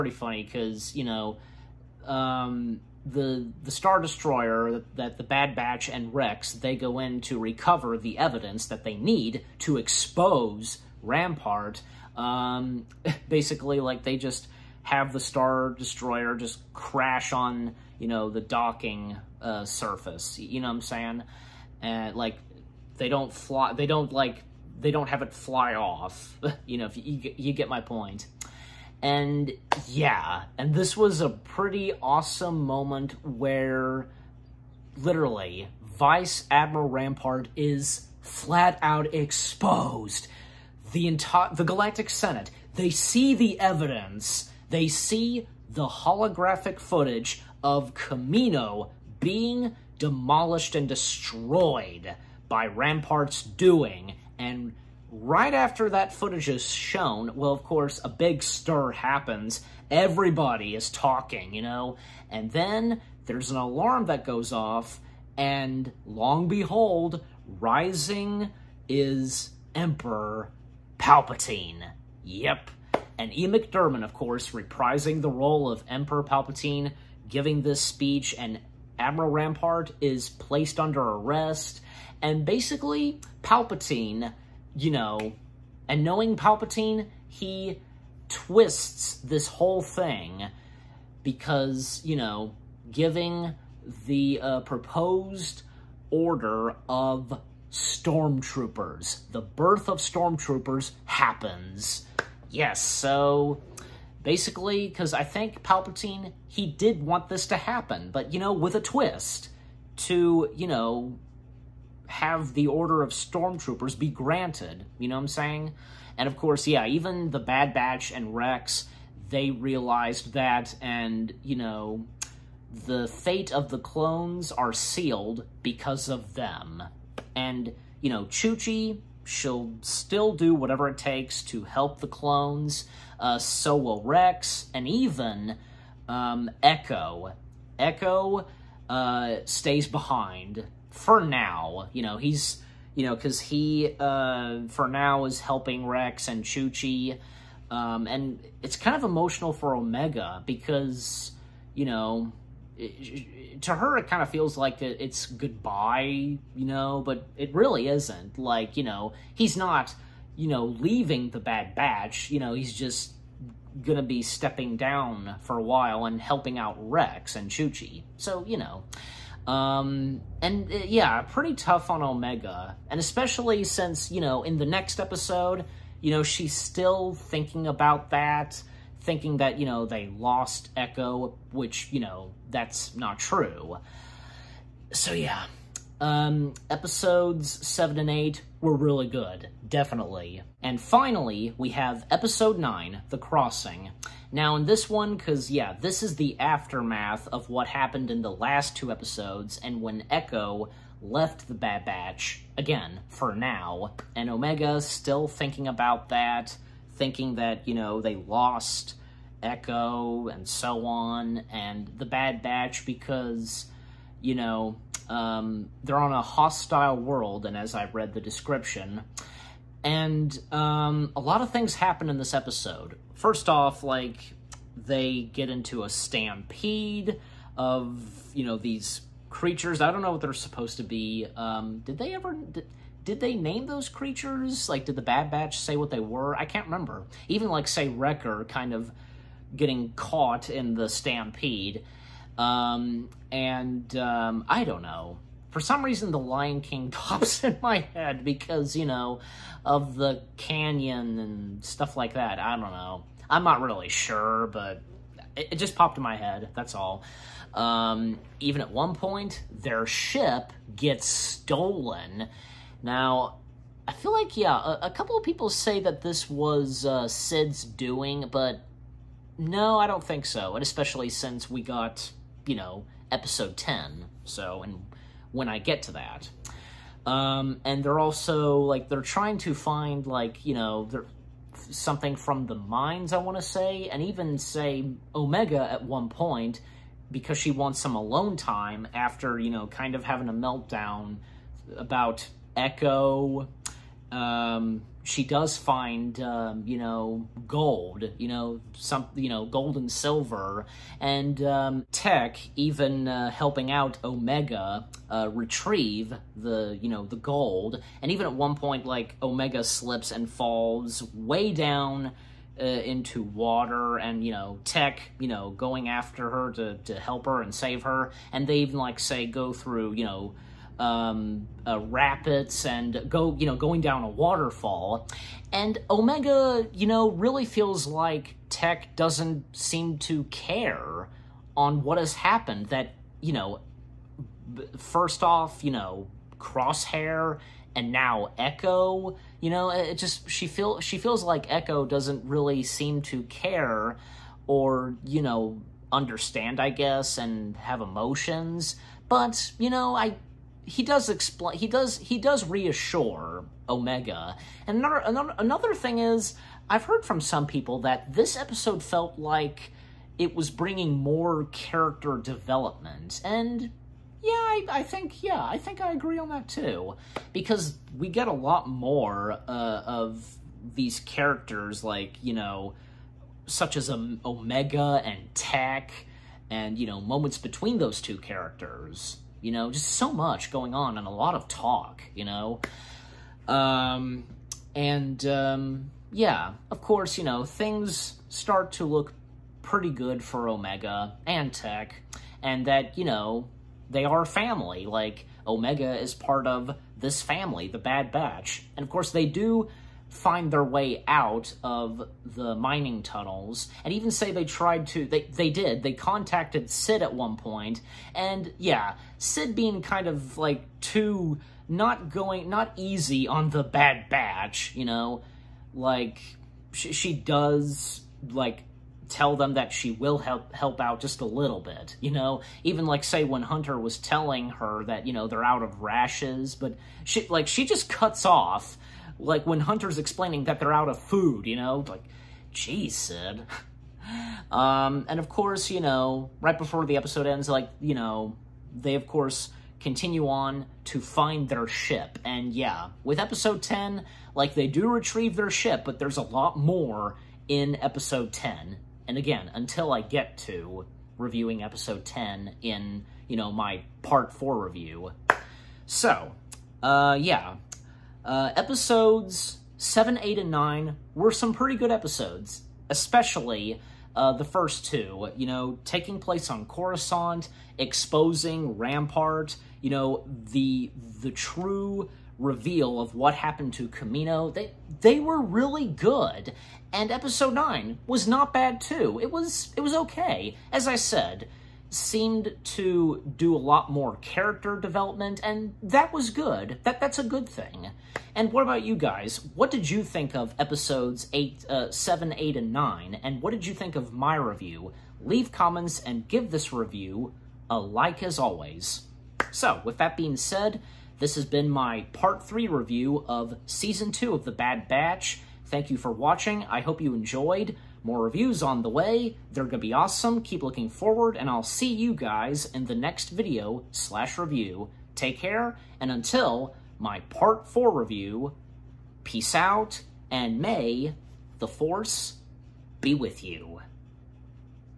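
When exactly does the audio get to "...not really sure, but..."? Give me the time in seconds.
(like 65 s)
253 s.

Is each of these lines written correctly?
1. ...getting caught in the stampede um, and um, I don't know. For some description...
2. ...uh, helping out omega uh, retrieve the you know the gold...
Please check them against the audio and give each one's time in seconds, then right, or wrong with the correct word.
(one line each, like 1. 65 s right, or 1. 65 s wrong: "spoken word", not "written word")
1. 239 s wrong: "reason", not "description"
2. 303 s right.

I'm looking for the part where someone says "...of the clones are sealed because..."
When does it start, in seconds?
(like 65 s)
123 s.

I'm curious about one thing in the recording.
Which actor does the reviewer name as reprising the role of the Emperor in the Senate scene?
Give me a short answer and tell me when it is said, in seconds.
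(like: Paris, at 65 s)
E. McDermott, at 73 s.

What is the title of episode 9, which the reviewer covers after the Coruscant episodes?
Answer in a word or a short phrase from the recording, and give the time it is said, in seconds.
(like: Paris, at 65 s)
The Crossing, at 193 s.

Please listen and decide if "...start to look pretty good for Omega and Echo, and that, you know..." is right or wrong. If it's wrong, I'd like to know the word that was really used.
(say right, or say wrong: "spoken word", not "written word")
wrong: "Tech", not "Echo".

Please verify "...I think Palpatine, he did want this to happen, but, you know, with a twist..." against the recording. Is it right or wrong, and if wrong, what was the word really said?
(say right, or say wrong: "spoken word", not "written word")
right.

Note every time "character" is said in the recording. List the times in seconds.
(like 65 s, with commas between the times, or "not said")
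361 s, 370 s, 378 s, 484 s.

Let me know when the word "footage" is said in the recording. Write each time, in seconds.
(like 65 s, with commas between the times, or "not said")
46 s, 56 s.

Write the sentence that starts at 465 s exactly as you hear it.
You know, taking place on Coruscant, exposing Rampart, you know, the, the true reveal of what happened to Kamino.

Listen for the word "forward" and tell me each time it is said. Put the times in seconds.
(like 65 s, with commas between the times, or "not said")
510 s.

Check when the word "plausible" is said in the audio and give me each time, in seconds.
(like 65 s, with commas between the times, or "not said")
not said.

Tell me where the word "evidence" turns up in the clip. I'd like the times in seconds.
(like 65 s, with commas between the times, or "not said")
8 s, 43 s.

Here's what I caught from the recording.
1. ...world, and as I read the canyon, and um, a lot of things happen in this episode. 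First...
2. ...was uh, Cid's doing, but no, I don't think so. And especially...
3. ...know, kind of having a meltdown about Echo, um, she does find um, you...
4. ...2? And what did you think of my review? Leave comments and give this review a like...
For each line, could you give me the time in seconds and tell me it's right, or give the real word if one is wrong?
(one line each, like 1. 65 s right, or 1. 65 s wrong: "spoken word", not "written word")
1. 216 s wrong: "description", not "canyon"
2. 266 s right
3. 289 s right
4. 492 s wrong: "9", not "2".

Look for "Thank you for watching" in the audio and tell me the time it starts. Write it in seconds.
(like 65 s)
505 s.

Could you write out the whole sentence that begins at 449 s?
And again, until I get to reviewing episode 10 in, you know, my part 4 review.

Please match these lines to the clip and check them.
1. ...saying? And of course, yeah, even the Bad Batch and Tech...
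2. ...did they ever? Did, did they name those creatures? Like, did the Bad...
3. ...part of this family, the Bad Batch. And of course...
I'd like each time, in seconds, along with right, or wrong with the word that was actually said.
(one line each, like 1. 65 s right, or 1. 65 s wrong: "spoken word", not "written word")
1. 115 s wrong: "Rex", not "Tech"
2. 231 s right
3. 396 s right.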